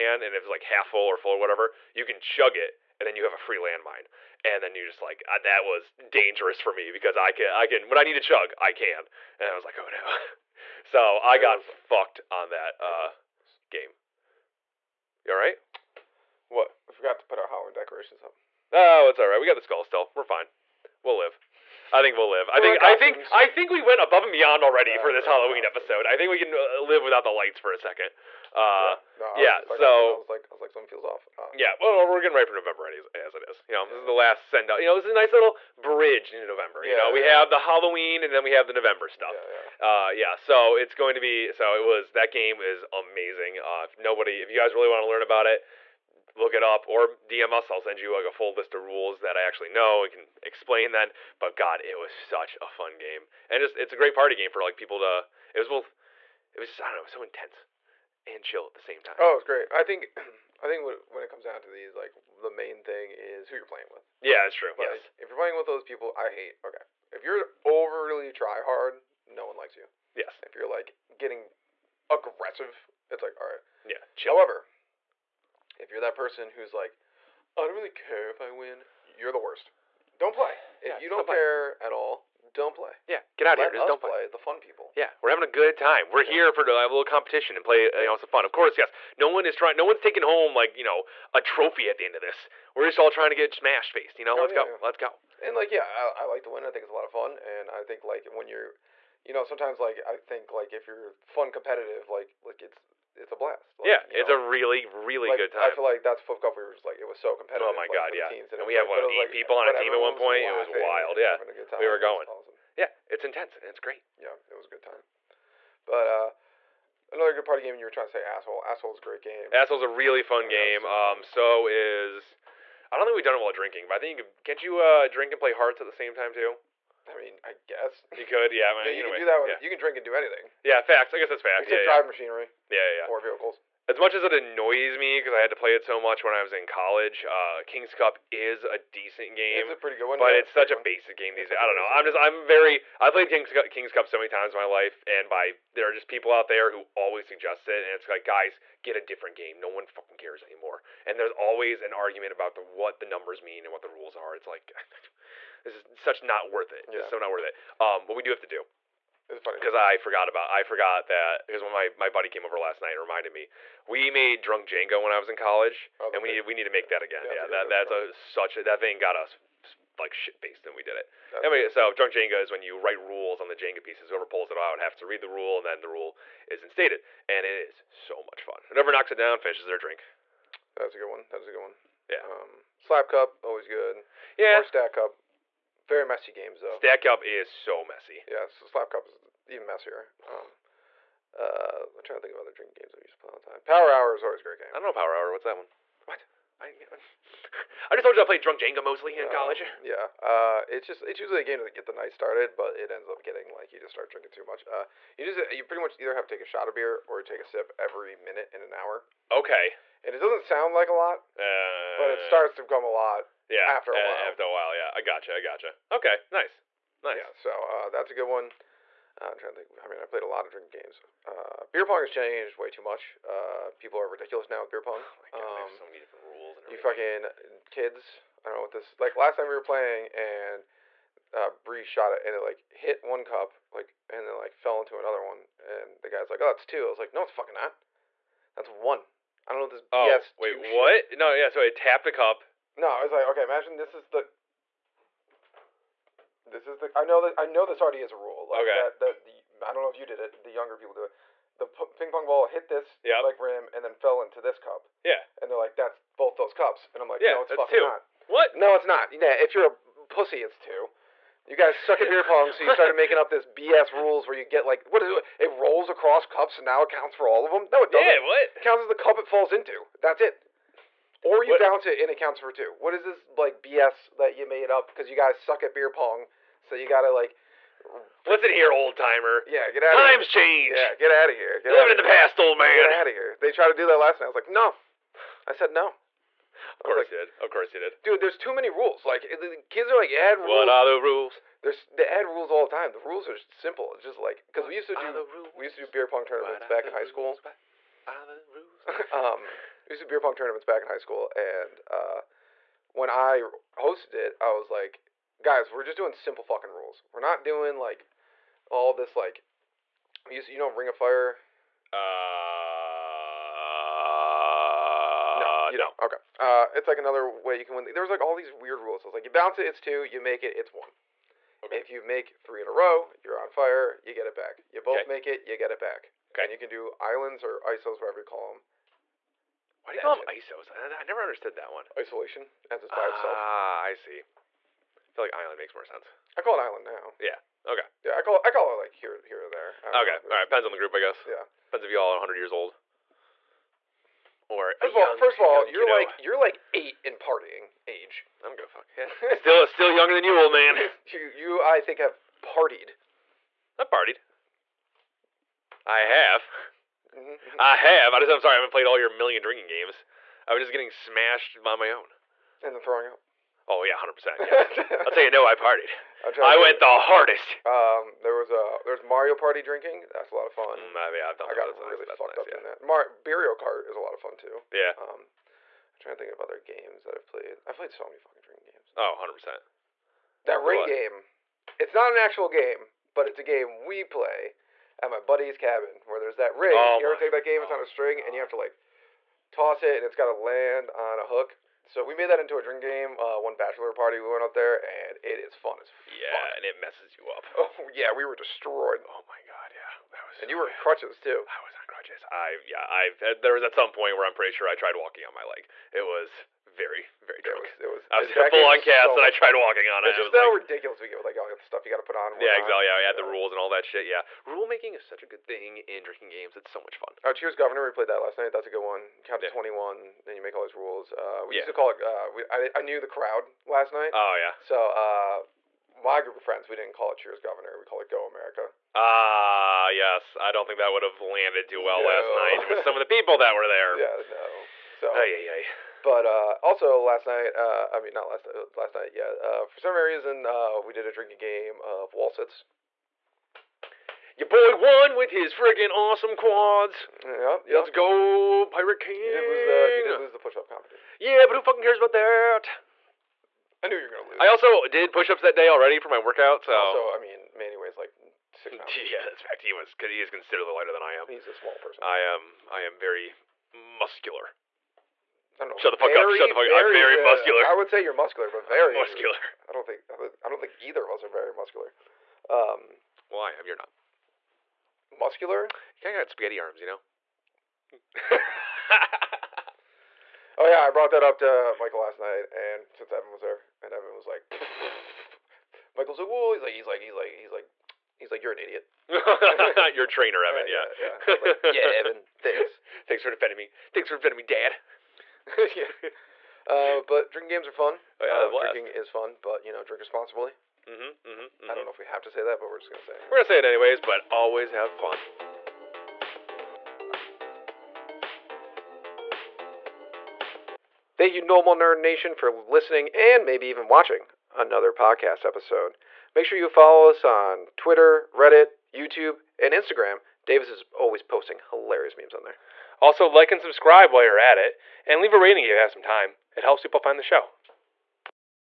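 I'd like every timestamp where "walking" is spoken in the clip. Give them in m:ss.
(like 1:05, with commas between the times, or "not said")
6:44, 6:49.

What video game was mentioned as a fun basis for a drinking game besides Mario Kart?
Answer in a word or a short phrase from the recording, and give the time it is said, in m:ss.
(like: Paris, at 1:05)
Mario Party, at 6:09.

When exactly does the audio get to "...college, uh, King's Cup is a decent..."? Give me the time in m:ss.
2:16.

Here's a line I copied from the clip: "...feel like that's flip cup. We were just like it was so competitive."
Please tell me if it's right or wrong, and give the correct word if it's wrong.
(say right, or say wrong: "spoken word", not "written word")
right.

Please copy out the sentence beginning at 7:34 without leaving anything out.
I also did push-ups that day already for my workout.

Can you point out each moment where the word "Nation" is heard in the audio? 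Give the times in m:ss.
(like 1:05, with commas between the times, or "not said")
8:31.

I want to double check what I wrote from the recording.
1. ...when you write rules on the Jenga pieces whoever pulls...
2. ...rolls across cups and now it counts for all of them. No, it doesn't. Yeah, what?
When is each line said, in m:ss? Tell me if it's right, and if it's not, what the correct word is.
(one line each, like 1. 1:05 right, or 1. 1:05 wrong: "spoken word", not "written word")
1. 2:52 right
2. 4:25 right.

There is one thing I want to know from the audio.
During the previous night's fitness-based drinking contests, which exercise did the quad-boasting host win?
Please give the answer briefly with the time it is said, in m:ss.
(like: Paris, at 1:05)
Wall sits, at 7:22.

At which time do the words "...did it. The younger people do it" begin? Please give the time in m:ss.
4:10.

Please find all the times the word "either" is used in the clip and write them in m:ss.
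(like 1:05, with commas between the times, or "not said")
3:26, 7:50.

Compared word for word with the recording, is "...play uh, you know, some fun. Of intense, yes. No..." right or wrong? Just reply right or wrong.
wrong.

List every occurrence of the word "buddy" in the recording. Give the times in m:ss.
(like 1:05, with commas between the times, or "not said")
2:42, 6:25.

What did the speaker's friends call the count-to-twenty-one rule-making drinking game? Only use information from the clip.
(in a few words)
Go America.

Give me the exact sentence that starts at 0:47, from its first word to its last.
I'll send you like a full list of rules that I actually know and can explain then.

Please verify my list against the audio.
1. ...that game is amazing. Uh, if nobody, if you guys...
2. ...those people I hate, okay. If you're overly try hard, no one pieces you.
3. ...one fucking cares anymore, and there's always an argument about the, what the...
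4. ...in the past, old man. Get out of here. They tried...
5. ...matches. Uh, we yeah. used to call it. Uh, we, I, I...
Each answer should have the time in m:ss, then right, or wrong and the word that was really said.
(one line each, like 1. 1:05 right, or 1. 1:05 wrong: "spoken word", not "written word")
1. 0:42 right
2. 1:05 wrong: "likes", not "pieces"
3. 2:29 right
4. 4:41 right
5. 7:00 wrong: "rules", not "matches".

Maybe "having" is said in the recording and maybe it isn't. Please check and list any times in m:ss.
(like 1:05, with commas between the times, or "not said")
1:25.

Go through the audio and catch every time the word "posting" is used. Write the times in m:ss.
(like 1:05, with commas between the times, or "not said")
8:41.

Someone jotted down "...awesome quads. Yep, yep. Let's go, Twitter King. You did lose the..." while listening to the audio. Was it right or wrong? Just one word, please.
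wrong.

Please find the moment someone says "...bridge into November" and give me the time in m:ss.
0:35.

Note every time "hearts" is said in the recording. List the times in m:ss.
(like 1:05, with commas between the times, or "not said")
2:05.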